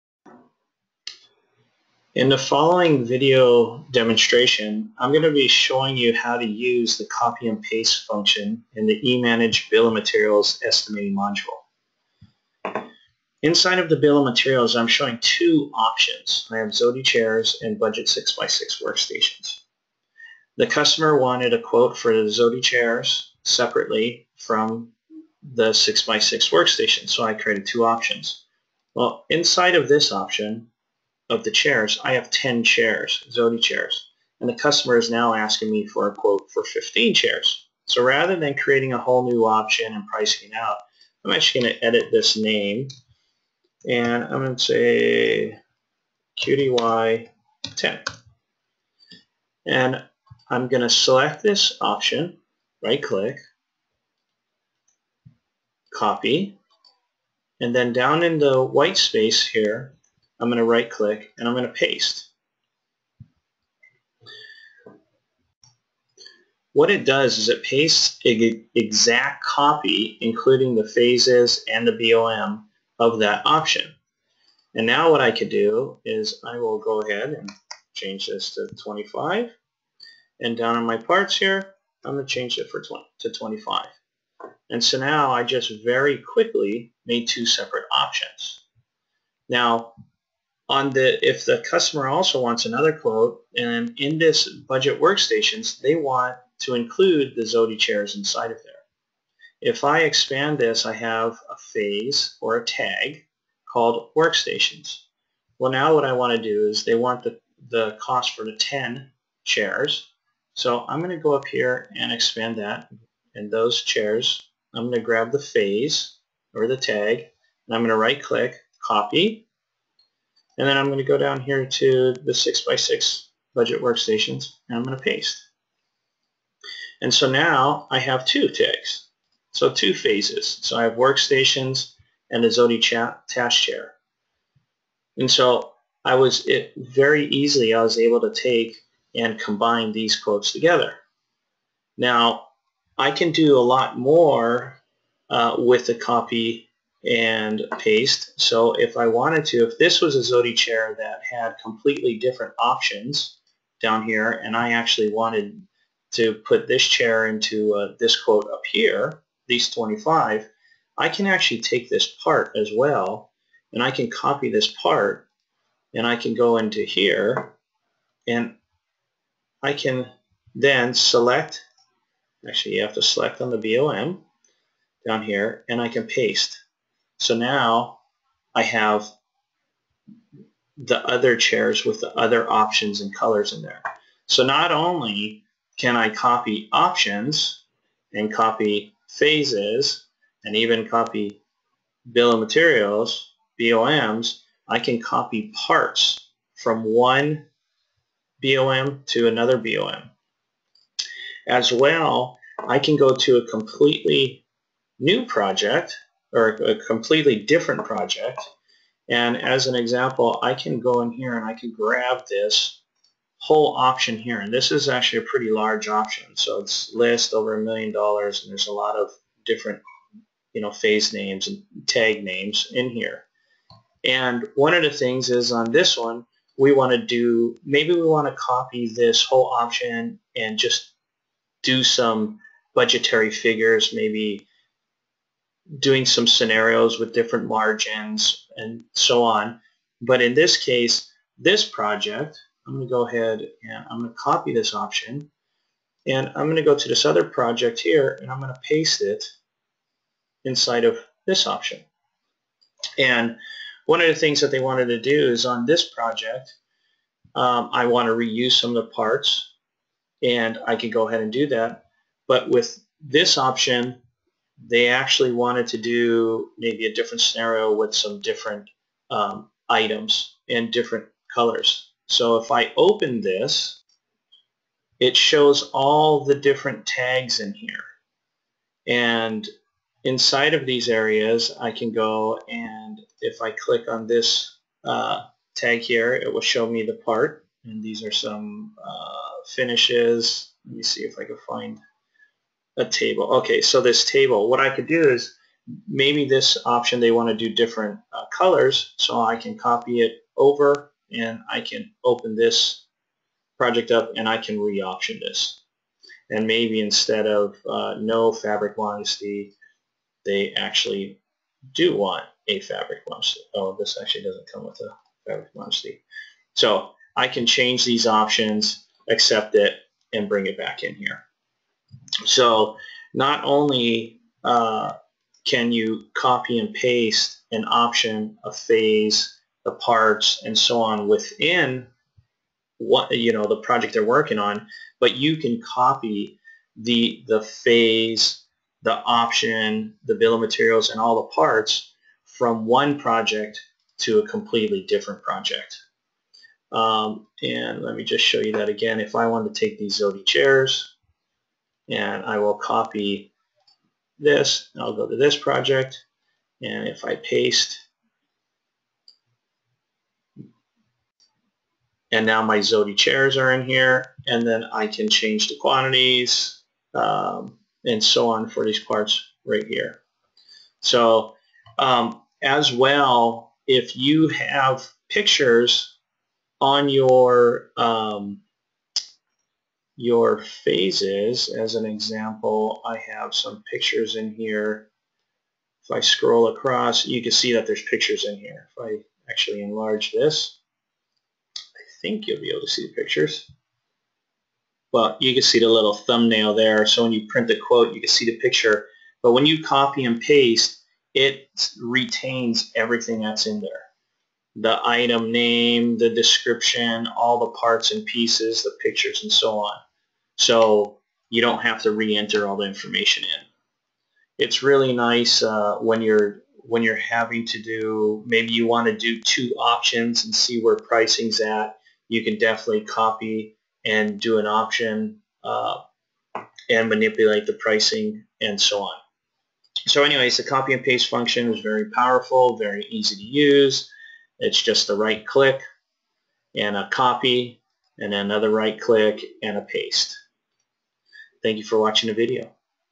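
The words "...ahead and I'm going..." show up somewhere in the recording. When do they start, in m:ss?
4:03.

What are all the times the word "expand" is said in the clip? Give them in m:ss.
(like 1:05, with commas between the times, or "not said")
1:40, 1:52.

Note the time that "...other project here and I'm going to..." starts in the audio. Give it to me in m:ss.
4:07.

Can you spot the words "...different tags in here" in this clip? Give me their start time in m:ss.
4:36.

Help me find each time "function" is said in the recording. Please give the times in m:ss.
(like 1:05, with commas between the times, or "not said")
0:08, 7:11.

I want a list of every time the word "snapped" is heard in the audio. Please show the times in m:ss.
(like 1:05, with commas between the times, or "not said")
not said.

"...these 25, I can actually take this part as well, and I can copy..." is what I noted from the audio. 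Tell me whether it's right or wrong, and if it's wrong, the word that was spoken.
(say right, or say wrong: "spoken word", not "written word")
right.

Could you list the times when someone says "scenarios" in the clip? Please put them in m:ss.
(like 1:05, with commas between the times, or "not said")
3:56, 4:27.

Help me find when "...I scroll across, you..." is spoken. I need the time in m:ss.
6:25.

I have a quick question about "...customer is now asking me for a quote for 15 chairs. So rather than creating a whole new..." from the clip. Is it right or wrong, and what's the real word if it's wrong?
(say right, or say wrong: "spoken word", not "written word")
right.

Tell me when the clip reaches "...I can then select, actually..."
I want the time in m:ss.
2:49.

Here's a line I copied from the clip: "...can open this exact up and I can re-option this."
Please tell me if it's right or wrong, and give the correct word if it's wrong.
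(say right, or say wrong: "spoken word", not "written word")
wrong: "project", not "exact".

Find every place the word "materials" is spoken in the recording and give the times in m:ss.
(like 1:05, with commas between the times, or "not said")
0:09, 0:14, 3:12, 5:40.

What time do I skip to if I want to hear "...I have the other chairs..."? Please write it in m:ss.
2:58.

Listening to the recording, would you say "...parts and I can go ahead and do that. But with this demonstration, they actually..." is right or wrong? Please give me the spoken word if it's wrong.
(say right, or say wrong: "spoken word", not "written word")
wrong: "option", not "demonstration".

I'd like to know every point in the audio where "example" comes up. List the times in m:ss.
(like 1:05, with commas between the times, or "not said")
3:29, 6:21.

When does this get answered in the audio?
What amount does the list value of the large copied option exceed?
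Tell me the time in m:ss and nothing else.
3:37.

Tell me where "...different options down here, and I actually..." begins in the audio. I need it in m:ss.
2:32.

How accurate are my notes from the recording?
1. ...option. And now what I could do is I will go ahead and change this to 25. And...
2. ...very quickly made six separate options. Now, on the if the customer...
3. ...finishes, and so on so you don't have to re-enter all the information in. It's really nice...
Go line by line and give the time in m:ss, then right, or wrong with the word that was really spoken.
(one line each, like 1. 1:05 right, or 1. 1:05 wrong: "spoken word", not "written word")
1. 1:13 right
2. 1:25 wrong: "two", not "six"
3. 6:48 wrong: "pictures", not "finishes".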